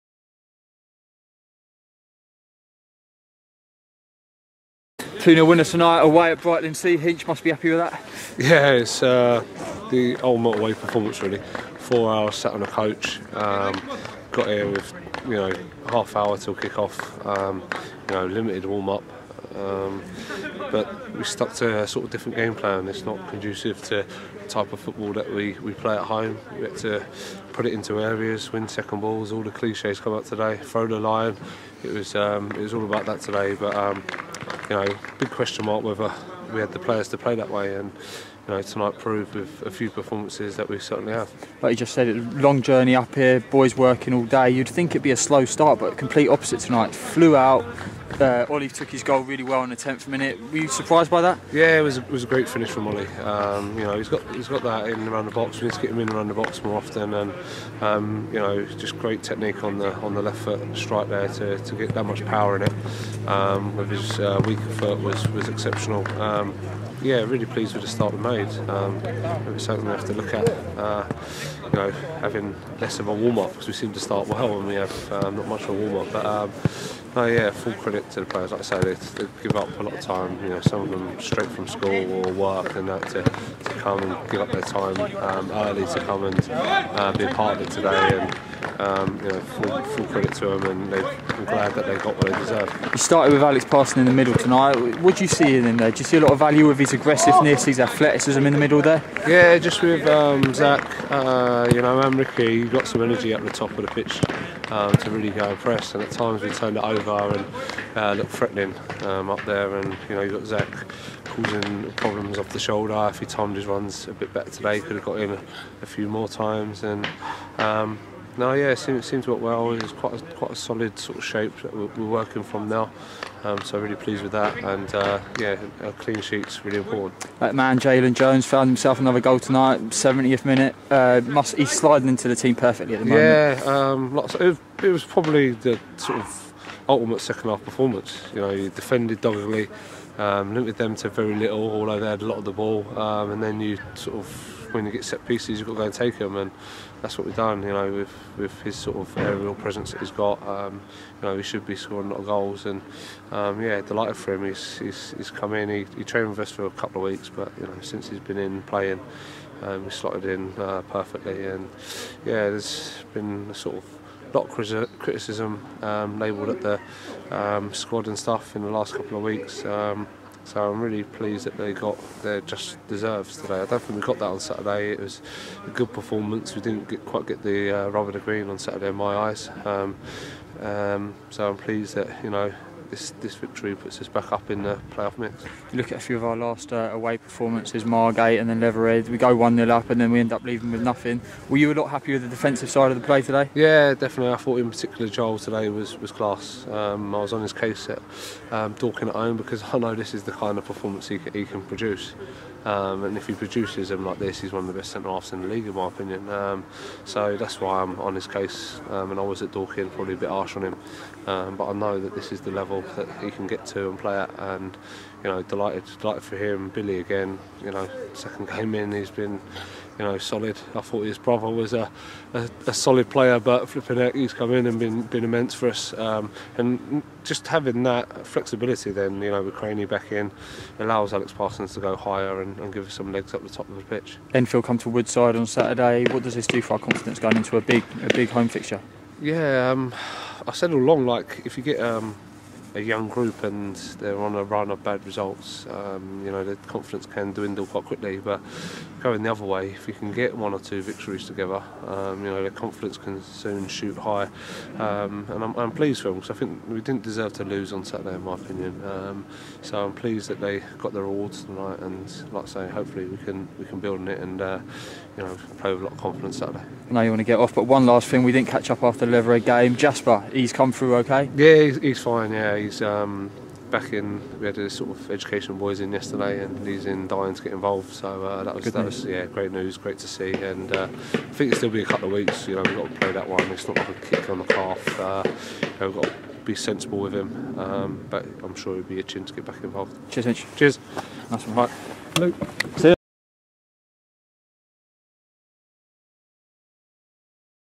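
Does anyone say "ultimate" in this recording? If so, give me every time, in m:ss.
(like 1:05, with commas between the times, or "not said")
0:10, 2:16.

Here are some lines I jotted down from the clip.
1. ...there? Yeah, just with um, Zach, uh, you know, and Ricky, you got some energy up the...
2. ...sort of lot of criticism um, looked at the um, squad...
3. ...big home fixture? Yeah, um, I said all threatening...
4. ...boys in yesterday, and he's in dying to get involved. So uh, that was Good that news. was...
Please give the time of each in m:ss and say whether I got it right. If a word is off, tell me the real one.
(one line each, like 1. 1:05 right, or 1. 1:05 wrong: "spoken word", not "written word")
1. 1:38 right
2. 2:43 wrong: "labelled", not "looked"
3. 3:58 wrong: "along", not "threatening"
4. 4:35 right.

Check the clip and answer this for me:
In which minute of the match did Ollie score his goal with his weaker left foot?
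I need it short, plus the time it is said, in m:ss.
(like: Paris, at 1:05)
10th minute, at 0:49.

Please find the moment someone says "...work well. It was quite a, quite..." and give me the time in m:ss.
1:59.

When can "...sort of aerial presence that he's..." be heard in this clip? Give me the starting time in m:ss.
2:28.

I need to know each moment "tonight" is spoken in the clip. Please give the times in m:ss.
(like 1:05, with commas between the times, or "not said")
0:05, 0:38, 0:46, 1:34, 2:09, 4:21.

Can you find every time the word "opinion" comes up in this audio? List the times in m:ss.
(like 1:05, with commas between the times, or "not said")
3:25, 4:18.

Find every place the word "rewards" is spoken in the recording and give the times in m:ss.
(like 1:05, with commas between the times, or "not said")
4:21.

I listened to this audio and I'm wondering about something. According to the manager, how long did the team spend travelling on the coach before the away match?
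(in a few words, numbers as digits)
4 hours.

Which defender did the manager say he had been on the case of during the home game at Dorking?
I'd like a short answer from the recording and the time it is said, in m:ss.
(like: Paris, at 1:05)
Joel, at 3:15.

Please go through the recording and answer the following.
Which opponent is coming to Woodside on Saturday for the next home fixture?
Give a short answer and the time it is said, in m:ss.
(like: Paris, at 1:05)
Enfield, at 3:54.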